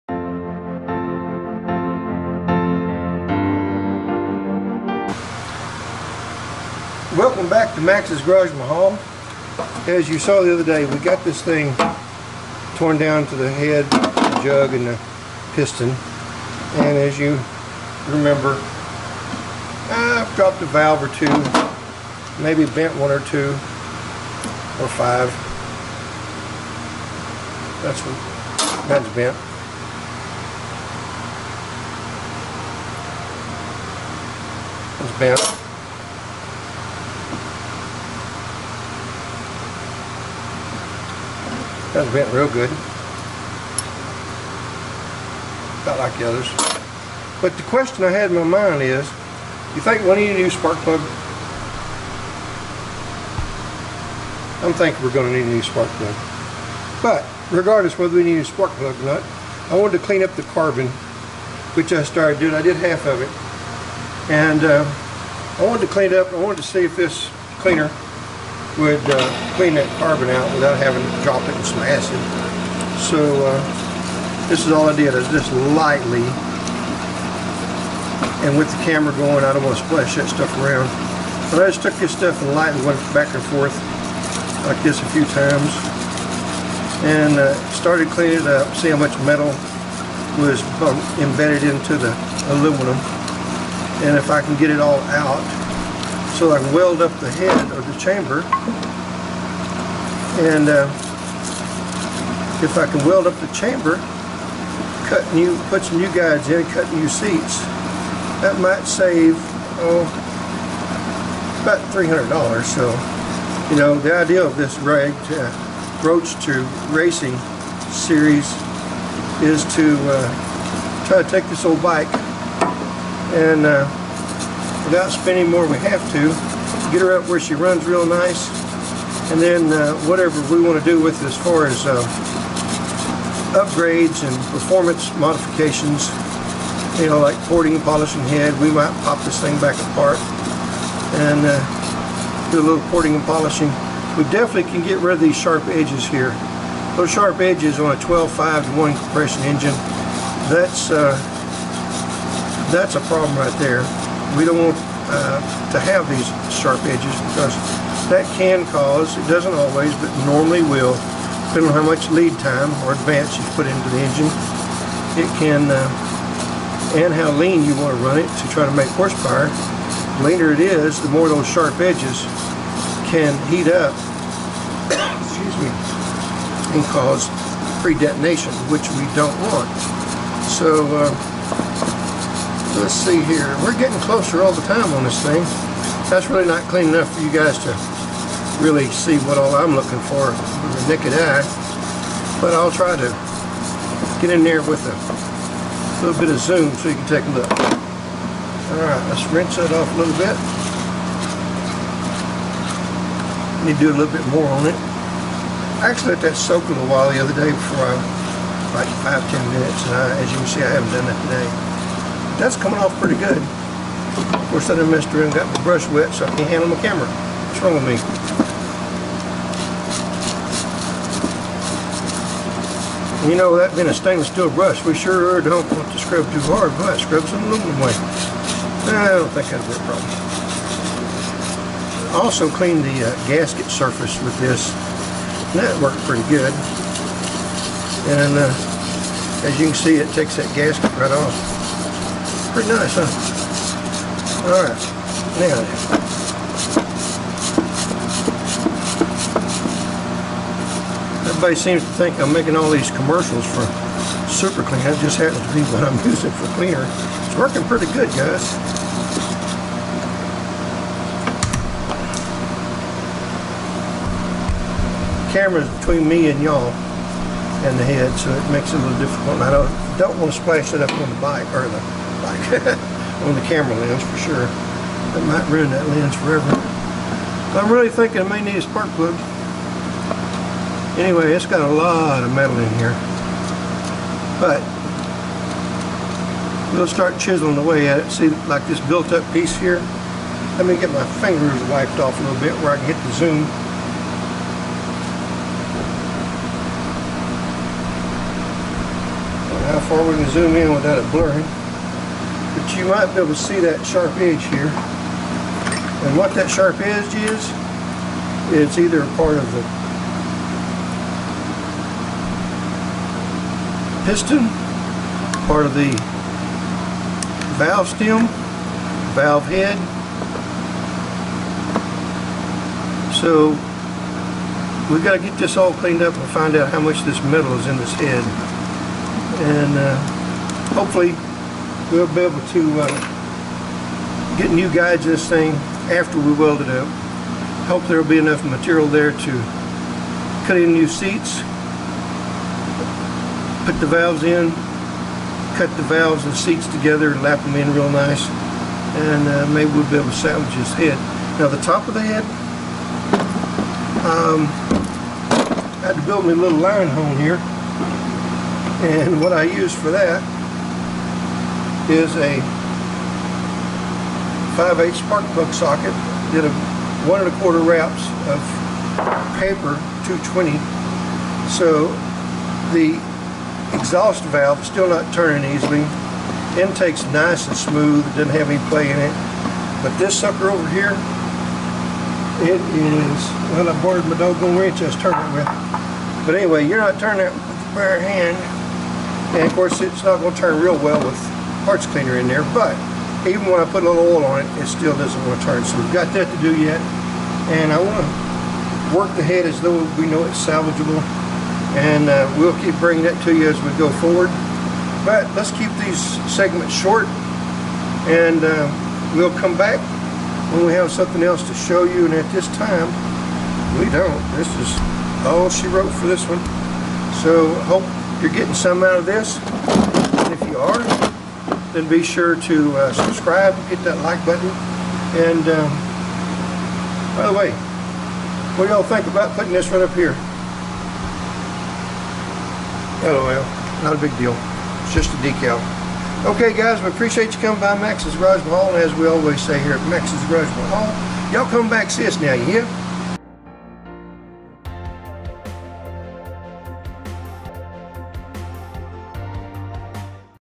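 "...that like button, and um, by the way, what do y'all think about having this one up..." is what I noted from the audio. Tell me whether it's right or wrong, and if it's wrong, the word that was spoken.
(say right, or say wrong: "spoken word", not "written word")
wrong: "putting", not "having".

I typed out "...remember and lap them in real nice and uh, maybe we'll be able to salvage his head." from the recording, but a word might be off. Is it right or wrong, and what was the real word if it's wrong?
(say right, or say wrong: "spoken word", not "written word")
wrong: "together", not "remember".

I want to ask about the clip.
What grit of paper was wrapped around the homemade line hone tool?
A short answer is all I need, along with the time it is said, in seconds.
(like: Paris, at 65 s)
220, at 370 s.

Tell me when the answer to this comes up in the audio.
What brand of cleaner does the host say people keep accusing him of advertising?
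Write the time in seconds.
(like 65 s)
254 s.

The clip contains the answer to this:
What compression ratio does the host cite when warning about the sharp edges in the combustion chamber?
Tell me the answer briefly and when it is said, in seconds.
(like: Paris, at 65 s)
12.5 to 1, at 147 s.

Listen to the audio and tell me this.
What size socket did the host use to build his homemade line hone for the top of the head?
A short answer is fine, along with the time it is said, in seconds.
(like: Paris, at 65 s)
5/8 spark plug socket, at 364 s.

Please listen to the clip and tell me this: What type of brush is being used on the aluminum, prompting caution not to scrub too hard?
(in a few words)
stainless steel.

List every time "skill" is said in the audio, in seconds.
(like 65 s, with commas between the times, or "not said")
not said.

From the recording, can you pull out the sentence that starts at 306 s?
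And what that sharp edge is, it's either a part of the piston, part of the valve stem, valve head.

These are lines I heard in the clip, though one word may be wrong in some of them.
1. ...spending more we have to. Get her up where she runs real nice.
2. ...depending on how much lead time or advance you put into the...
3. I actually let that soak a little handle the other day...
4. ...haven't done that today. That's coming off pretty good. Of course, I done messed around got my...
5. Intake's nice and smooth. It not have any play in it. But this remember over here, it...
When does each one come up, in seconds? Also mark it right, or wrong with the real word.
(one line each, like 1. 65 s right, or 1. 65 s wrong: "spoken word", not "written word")
1. 125 s right
2. 161 s right
3. 205 s wrong: "while", not "handle"
4. 210 s right
5. 376 s wrong: "sucker", not "remember".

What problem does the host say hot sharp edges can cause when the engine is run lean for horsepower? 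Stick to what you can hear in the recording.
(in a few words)
pre-detonation.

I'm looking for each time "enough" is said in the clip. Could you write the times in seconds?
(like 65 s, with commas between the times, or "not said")
186 s, 338 s.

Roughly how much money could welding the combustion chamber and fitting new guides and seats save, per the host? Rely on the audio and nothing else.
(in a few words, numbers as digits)
$300.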